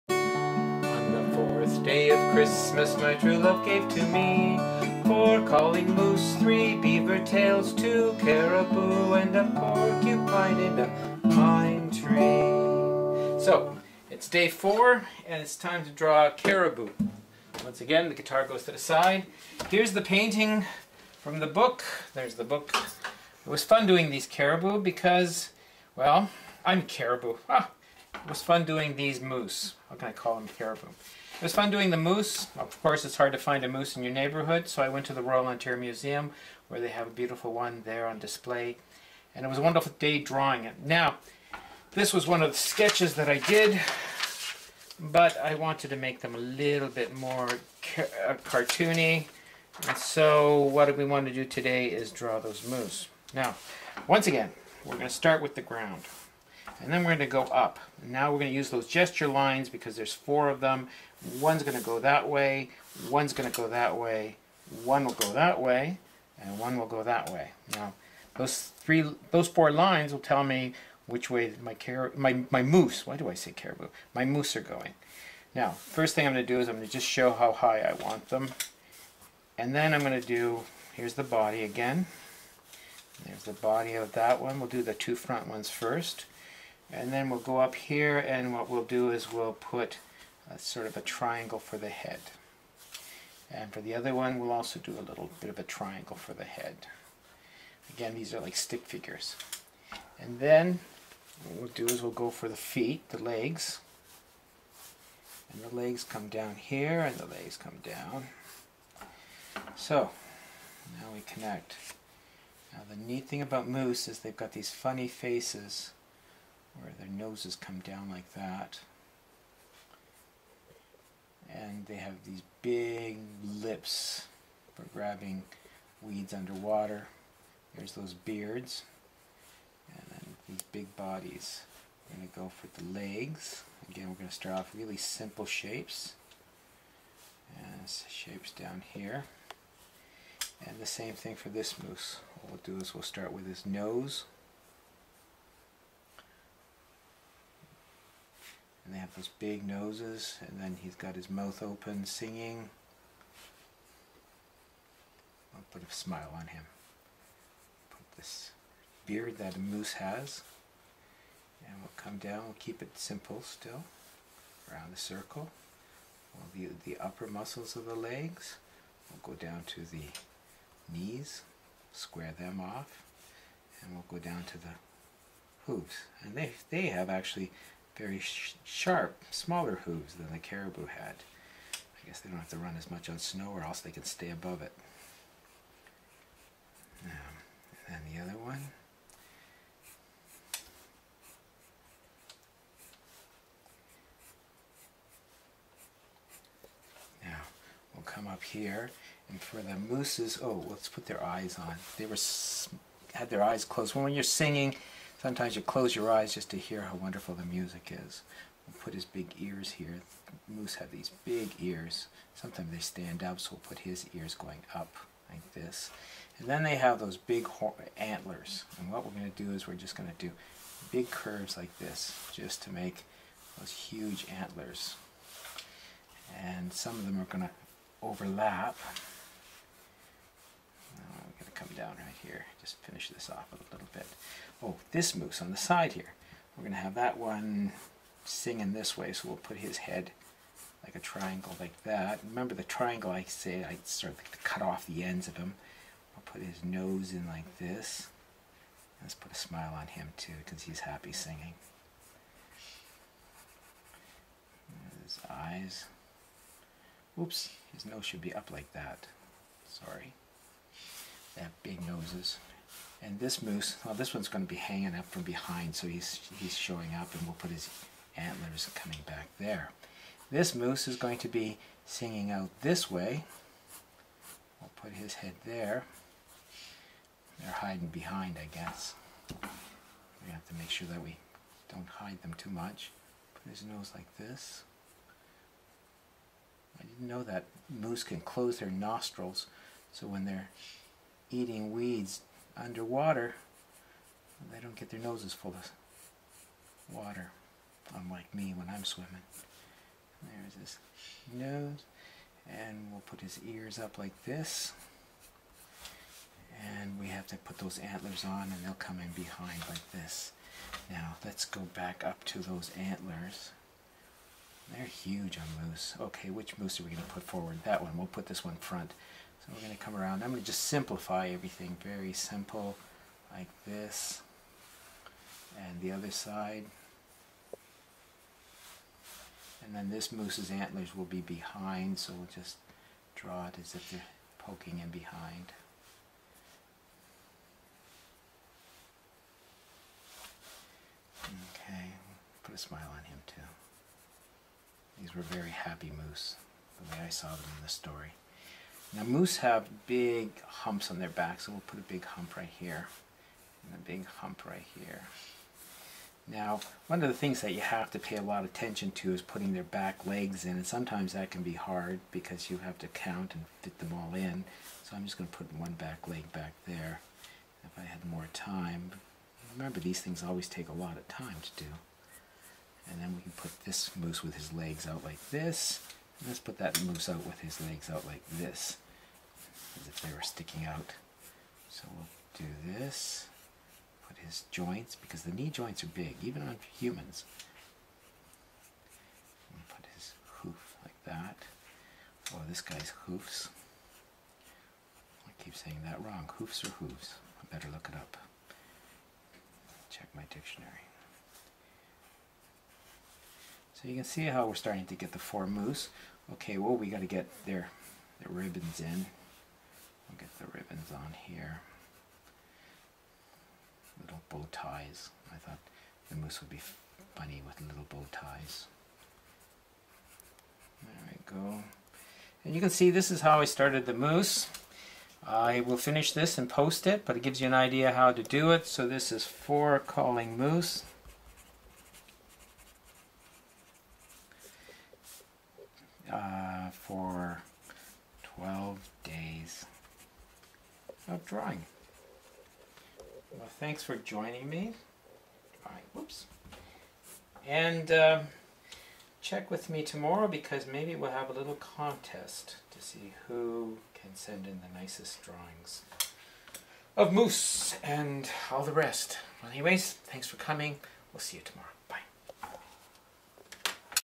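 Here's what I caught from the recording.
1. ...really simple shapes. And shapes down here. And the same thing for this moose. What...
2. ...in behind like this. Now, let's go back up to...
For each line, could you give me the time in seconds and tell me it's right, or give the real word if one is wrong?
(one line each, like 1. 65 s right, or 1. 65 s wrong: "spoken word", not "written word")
1. 134 s right
2. 308 s right.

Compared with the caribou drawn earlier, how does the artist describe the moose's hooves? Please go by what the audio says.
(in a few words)
Sharp, smaller hooves.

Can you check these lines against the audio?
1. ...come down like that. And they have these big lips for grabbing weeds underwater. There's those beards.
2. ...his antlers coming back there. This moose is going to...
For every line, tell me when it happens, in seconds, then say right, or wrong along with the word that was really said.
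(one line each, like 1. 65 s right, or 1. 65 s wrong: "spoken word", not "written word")
1. 117 s right
2. 267 s right.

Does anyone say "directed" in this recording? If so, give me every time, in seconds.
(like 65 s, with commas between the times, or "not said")
not said.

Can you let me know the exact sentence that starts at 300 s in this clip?
There's his nose, and we'll put his ears up like this.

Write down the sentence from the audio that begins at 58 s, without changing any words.
Now we're going to use those gesture lines because there's four of them.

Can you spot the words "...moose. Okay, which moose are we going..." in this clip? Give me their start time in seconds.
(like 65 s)
315 s.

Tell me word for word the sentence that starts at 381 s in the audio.
So we'll do this, put his joints, because the knee joints are big, even on humans.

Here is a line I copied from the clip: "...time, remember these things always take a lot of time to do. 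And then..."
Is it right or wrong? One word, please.
right.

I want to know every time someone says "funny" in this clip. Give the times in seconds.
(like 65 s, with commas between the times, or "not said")
114 s, 417 s.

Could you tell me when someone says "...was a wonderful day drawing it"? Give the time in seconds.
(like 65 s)
39 s.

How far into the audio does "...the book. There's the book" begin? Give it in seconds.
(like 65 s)
21 s.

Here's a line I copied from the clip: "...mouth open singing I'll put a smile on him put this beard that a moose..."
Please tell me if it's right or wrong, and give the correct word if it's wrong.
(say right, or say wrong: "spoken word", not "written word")
right.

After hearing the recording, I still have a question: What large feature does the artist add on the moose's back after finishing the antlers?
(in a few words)
Big humps.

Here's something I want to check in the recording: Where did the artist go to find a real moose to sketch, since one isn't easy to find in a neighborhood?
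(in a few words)
Royal Ontario Museum.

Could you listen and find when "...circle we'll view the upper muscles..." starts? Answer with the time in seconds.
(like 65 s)
164 s.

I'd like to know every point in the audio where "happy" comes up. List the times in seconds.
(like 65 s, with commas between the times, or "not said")
250 s, 345 s.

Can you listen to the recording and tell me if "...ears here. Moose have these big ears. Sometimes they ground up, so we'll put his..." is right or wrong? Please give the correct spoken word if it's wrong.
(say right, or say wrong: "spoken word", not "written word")
wrong: "stand", not "ground".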